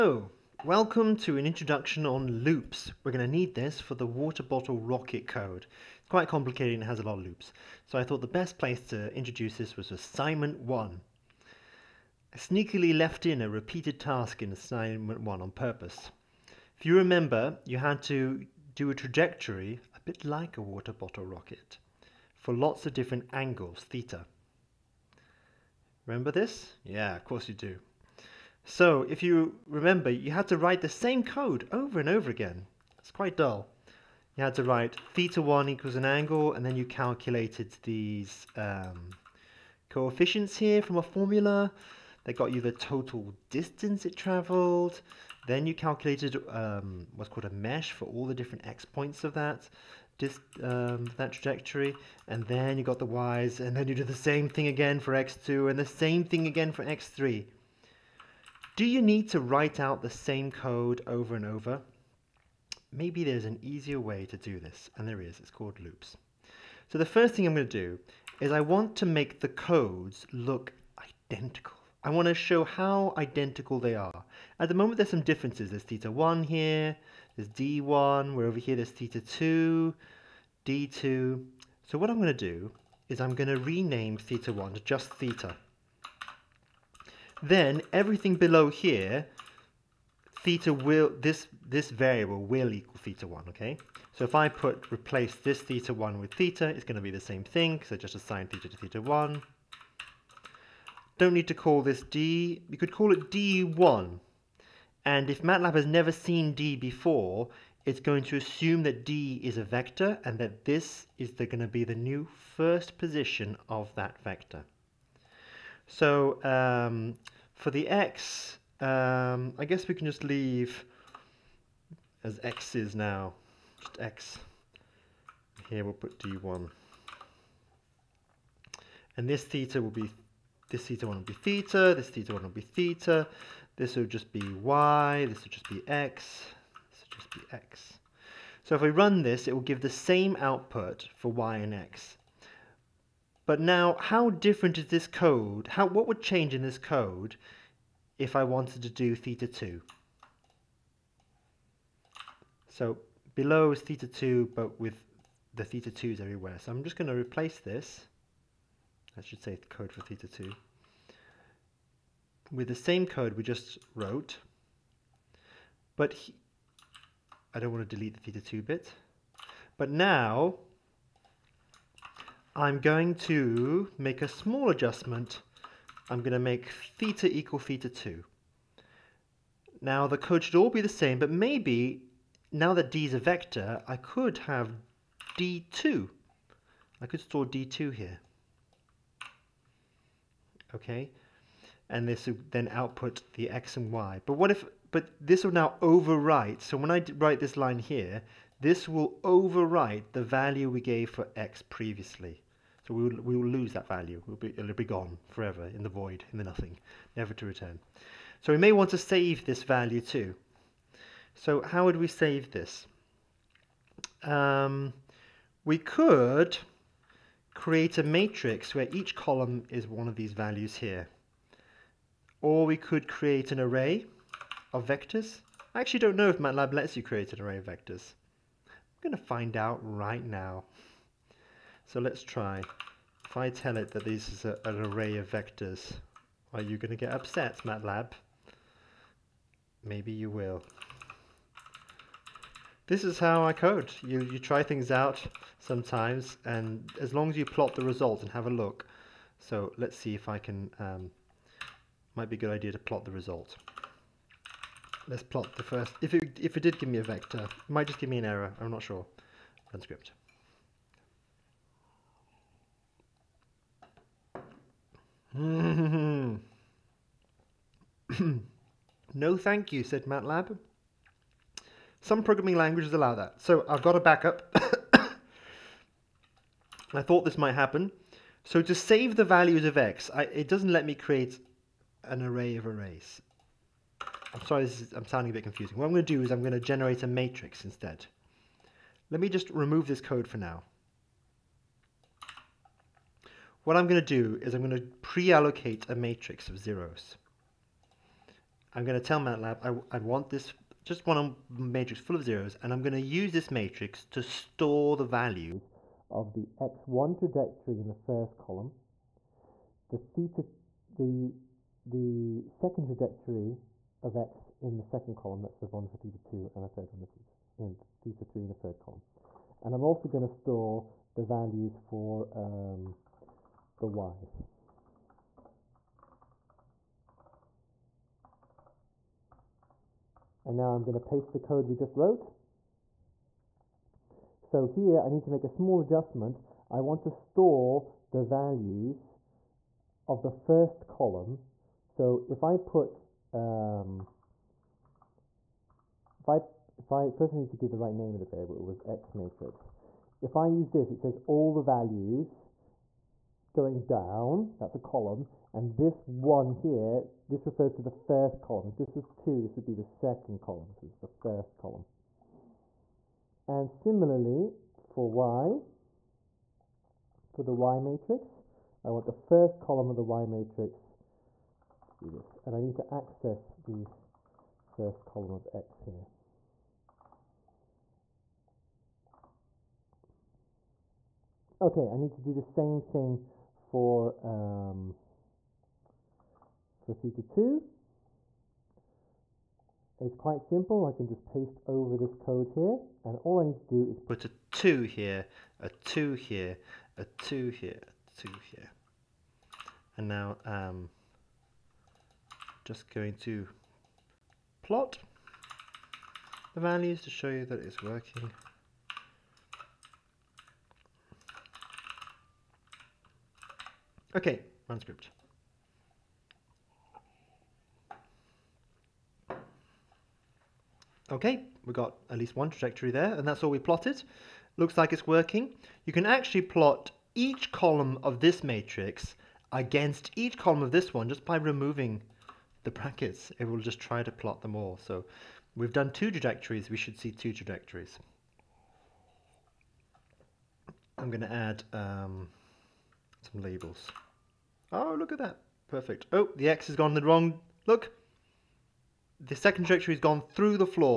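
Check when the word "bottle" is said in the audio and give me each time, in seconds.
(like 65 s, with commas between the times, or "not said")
4 s, 20 s.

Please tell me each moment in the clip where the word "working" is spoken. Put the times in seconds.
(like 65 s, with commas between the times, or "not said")
407 s, 425 s.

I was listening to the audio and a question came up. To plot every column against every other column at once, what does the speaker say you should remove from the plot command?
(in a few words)
the brackets.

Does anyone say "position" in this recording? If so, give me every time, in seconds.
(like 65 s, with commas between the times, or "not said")
112 s.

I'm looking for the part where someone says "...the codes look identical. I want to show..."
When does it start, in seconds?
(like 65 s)
69 s.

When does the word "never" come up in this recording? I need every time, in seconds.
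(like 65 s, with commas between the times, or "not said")
105 s, 207 s.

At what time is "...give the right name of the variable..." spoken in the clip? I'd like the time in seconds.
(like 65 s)
347 s.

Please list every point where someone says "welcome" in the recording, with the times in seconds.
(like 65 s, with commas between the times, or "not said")
0 s.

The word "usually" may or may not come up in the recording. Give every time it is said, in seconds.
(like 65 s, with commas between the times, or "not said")
not said.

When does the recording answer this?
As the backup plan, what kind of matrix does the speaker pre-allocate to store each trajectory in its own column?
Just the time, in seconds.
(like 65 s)
295 s.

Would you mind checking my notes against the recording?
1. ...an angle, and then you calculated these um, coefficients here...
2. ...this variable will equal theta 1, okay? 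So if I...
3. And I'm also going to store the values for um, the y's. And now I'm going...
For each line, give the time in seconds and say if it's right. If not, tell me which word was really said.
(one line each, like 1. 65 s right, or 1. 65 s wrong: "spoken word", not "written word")
1. 35 s right
2. 91 s right
3. 319 s right.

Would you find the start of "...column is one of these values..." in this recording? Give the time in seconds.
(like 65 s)
219 s.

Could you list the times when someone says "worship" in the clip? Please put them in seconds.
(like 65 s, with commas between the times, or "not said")
not said.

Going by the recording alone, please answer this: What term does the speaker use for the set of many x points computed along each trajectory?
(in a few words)
mesh.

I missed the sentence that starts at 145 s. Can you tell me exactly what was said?
How What would change in this code if I wanted to do theta 2?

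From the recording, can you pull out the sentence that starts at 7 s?
So I thought the best place to introduce this was assignment 1.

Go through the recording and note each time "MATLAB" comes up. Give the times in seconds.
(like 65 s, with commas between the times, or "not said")
105 s, 226 s, 237 s, 270 s, 299 s.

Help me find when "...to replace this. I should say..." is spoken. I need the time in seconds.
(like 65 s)
157 s.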